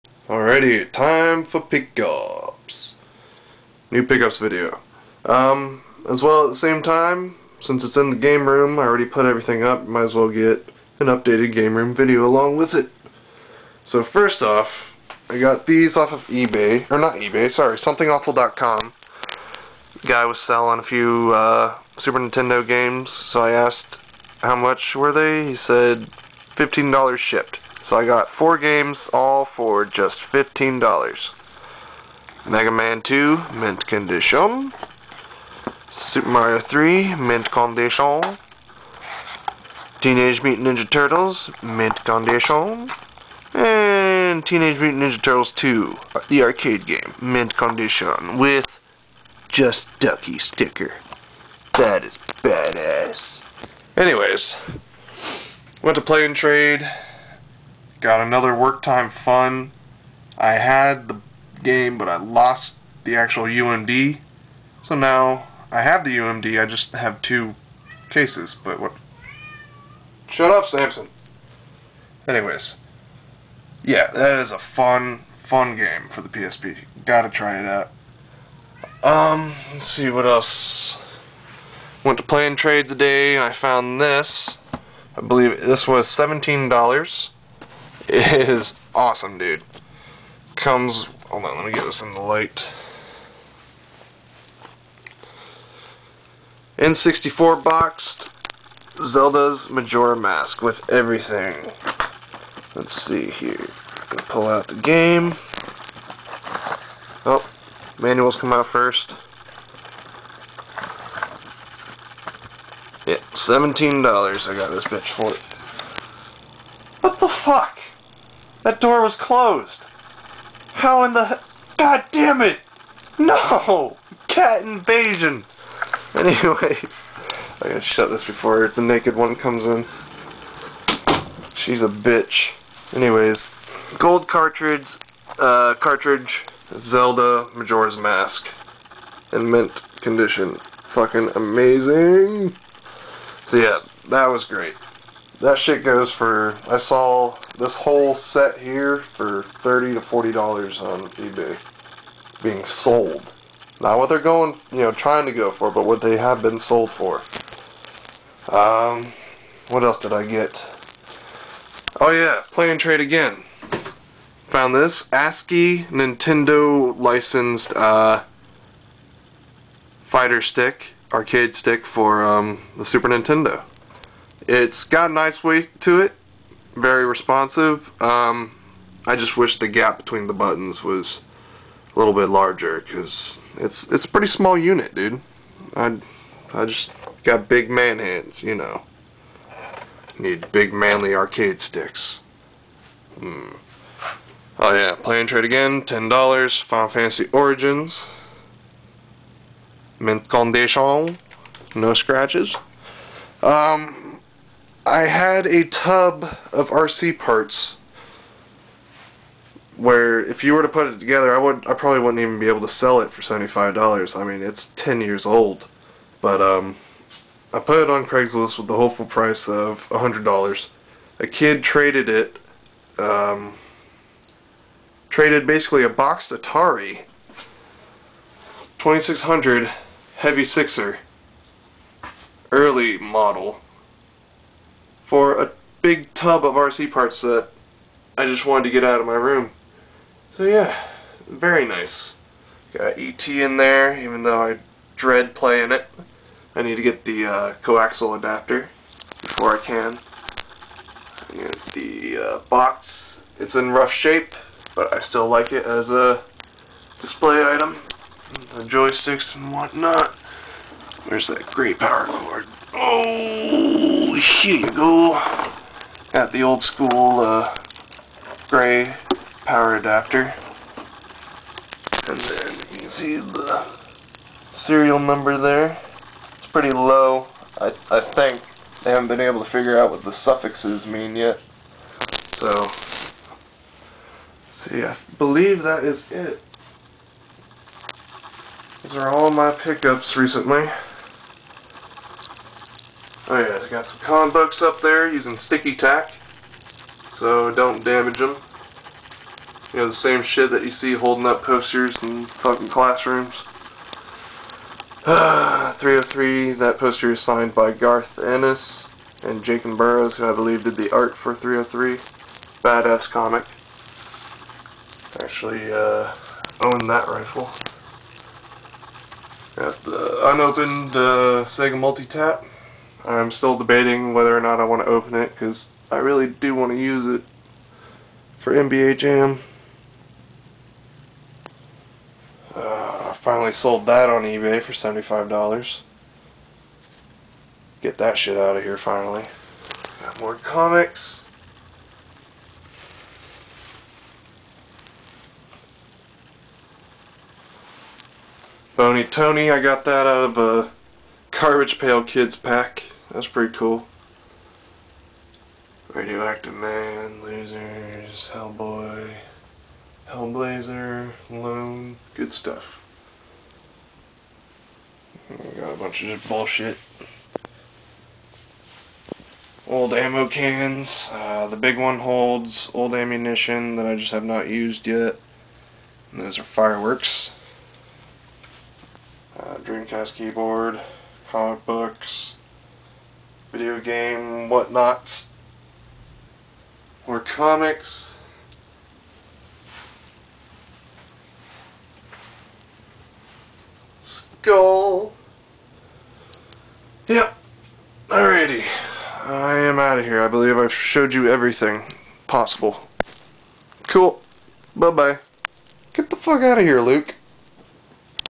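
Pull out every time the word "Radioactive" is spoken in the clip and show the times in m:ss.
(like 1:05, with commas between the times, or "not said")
5:55.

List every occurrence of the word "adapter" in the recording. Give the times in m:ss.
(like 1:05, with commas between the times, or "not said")
4:08, 4:29.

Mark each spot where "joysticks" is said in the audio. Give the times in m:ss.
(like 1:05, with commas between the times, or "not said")
4:18.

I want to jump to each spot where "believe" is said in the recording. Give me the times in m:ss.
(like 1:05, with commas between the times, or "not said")
1:25, 4:45, 5:10, 6:40.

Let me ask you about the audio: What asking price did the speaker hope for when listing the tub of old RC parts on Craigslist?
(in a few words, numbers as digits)
$100.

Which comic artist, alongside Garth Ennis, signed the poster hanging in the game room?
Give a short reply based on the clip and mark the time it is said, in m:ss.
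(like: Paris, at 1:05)
Jacen Burrows, at 5:09.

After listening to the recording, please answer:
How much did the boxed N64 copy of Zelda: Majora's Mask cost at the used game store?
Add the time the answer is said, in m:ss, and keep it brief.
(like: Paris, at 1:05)
$17, at 1:53.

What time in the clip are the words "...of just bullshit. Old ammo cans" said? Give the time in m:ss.
6:06.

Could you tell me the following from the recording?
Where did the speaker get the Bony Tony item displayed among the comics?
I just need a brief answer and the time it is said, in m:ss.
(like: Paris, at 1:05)
A Garbage Pail Kids pack, at 5:51.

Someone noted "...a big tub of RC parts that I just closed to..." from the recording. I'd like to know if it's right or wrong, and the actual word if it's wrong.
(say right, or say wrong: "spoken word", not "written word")
wrong: "wanted", not "closed".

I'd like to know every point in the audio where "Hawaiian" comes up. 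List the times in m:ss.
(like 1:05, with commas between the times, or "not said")
not said.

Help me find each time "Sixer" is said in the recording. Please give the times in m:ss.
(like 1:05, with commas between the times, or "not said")
3:50.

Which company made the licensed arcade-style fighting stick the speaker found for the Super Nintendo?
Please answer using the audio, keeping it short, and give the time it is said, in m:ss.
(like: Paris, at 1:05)
ASCII, at 2:45.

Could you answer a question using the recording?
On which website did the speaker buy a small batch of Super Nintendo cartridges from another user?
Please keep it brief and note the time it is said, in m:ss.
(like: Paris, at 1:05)
somethingawful.com, at 0:17.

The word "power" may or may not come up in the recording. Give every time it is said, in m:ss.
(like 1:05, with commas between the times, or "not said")
4:21, 4:29.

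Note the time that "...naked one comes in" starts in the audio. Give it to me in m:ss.
2:08.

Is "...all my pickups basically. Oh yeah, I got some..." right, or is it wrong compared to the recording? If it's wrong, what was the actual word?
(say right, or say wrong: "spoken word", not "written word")
wrong: "recently", not "basically".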